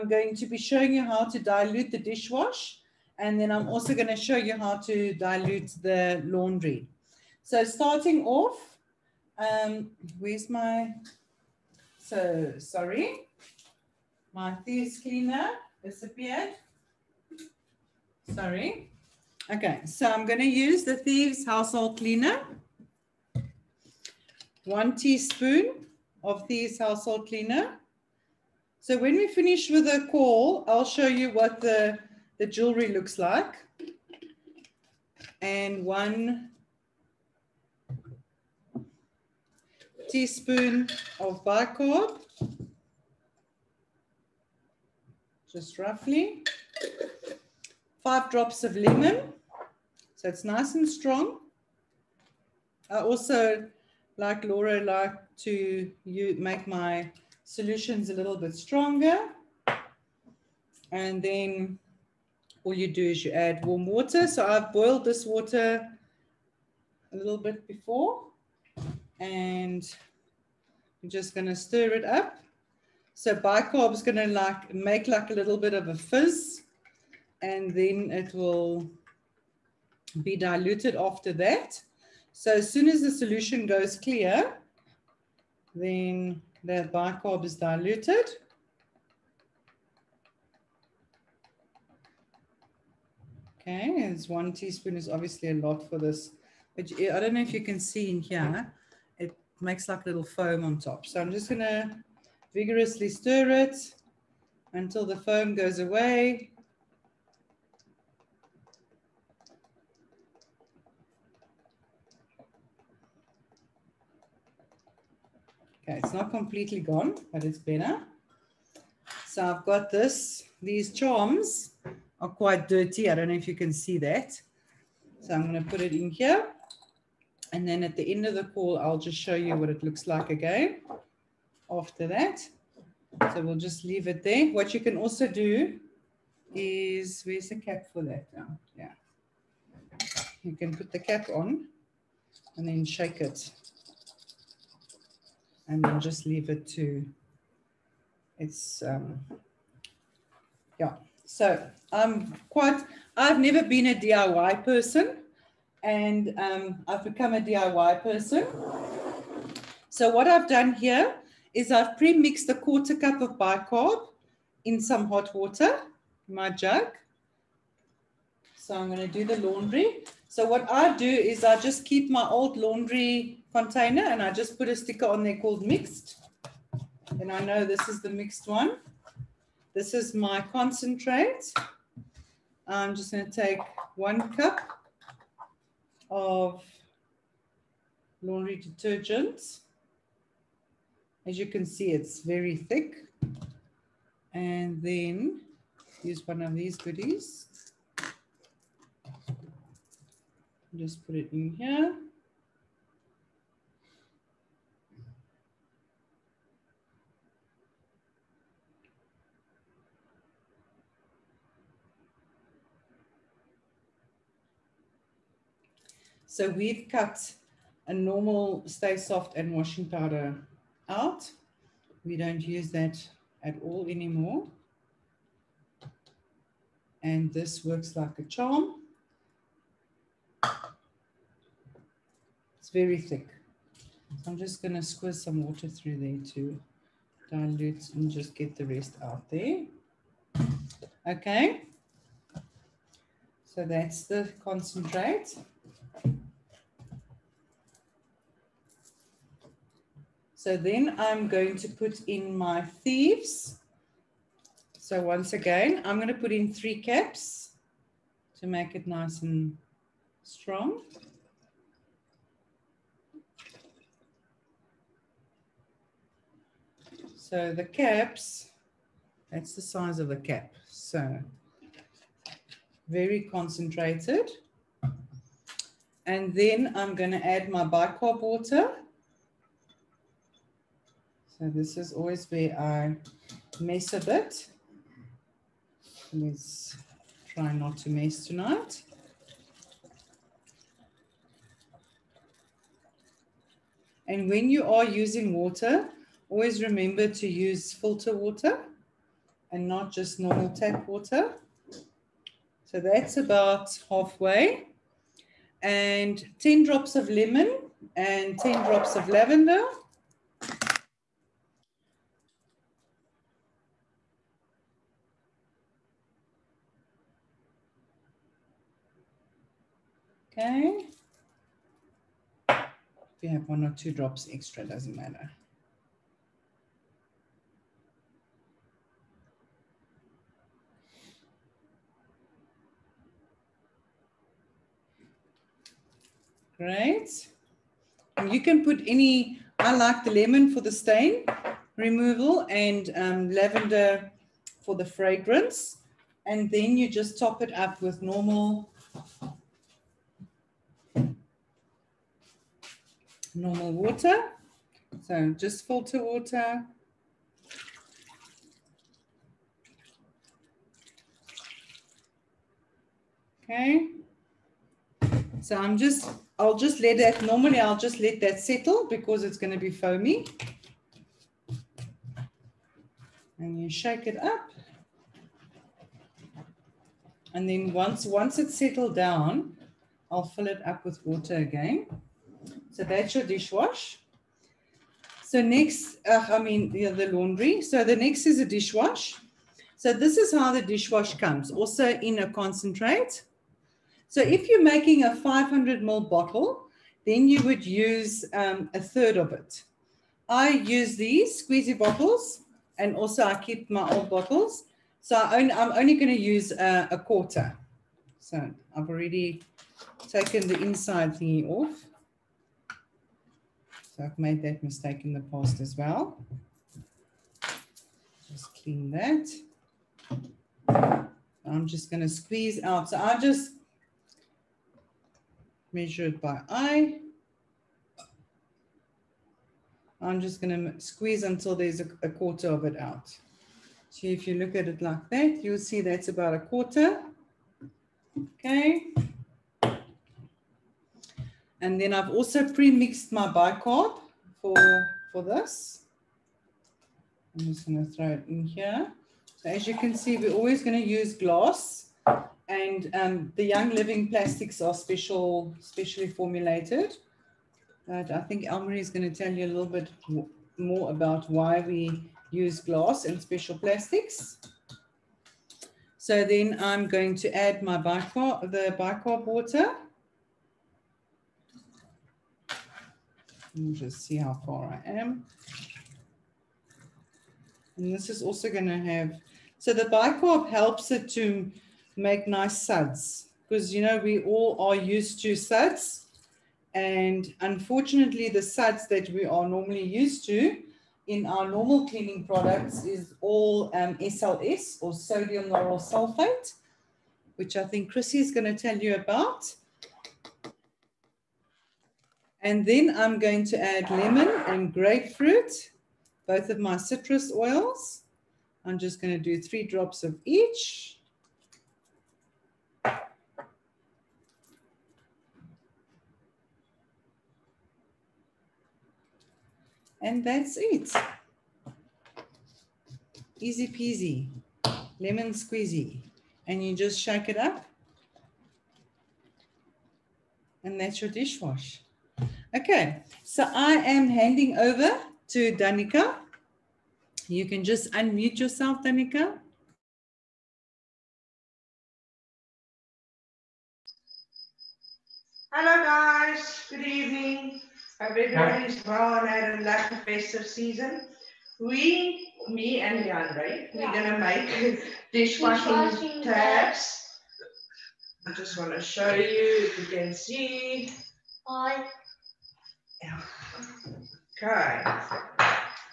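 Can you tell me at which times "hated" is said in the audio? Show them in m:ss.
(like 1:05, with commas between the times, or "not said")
not said.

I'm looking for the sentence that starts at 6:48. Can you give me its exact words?
So I've already taken the inside thingy off.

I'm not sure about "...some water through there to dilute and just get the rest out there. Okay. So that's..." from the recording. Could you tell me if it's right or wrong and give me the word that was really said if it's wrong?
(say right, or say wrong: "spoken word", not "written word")
right.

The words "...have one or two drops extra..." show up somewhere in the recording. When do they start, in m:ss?
5:23.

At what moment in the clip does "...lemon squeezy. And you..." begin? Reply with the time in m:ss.
8:44.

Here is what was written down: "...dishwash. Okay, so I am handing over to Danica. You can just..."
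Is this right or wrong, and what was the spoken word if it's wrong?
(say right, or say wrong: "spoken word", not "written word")
right.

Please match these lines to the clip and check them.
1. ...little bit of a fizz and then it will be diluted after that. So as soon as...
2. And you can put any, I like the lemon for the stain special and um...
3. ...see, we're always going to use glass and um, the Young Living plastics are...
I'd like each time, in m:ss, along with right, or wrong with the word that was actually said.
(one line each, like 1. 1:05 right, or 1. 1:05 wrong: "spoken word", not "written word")
1. 1:15 right
2. 5:38 wrong: "removal", not "special"
3. 7:29 right.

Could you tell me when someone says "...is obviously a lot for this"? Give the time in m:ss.
1:34.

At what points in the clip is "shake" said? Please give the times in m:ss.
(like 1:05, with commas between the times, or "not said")
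2:22, 6:13, 8:46.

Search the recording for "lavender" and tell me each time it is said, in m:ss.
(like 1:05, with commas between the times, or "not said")
5:09, 5:43.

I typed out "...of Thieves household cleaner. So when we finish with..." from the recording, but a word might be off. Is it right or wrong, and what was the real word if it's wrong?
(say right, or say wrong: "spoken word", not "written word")
right.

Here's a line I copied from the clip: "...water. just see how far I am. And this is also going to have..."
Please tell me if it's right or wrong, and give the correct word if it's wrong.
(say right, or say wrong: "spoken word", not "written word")
right.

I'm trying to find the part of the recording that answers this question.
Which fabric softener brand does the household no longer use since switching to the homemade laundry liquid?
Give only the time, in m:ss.
3:38.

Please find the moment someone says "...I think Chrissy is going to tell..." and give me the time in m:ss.
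8:17.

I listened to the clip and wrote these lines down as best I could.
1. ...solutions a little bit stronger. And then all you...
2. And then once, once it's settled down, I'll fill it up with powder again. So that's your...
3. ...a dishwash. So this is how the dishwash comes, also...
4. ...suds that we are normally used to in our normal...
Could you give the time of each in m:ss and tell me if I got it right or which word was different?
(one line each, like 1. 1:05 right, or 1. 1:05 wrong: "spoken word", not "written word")
1. 0:57 right
2. 6:17 wrong: "water", not "powder"
3. 6:28 right
4. 8:08 right.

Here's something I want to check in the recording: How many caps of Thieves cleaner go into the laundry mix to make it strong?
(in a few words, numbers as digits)
3.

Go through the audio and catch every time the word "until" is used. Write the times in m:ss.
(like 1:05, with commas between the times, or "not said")
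1:44, 7:11.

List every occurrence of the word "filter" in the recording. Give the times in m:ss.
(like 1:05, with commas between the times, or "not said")
4:57, 5:55.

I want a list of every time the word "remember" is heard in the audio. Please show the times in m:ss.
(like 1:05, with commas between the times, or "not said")
4:56.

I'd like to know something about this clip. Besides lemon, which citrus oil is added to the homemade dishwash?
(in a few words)
grapefruit.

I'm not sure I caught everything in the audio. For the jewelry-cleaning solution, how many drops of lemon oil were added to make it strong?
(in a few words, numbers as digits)
5.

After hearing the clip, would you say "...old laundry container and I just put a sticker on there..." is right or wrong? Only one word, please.
right.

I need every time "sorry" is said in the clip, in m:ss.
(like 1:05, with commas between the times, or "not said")
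0:12, 0:18.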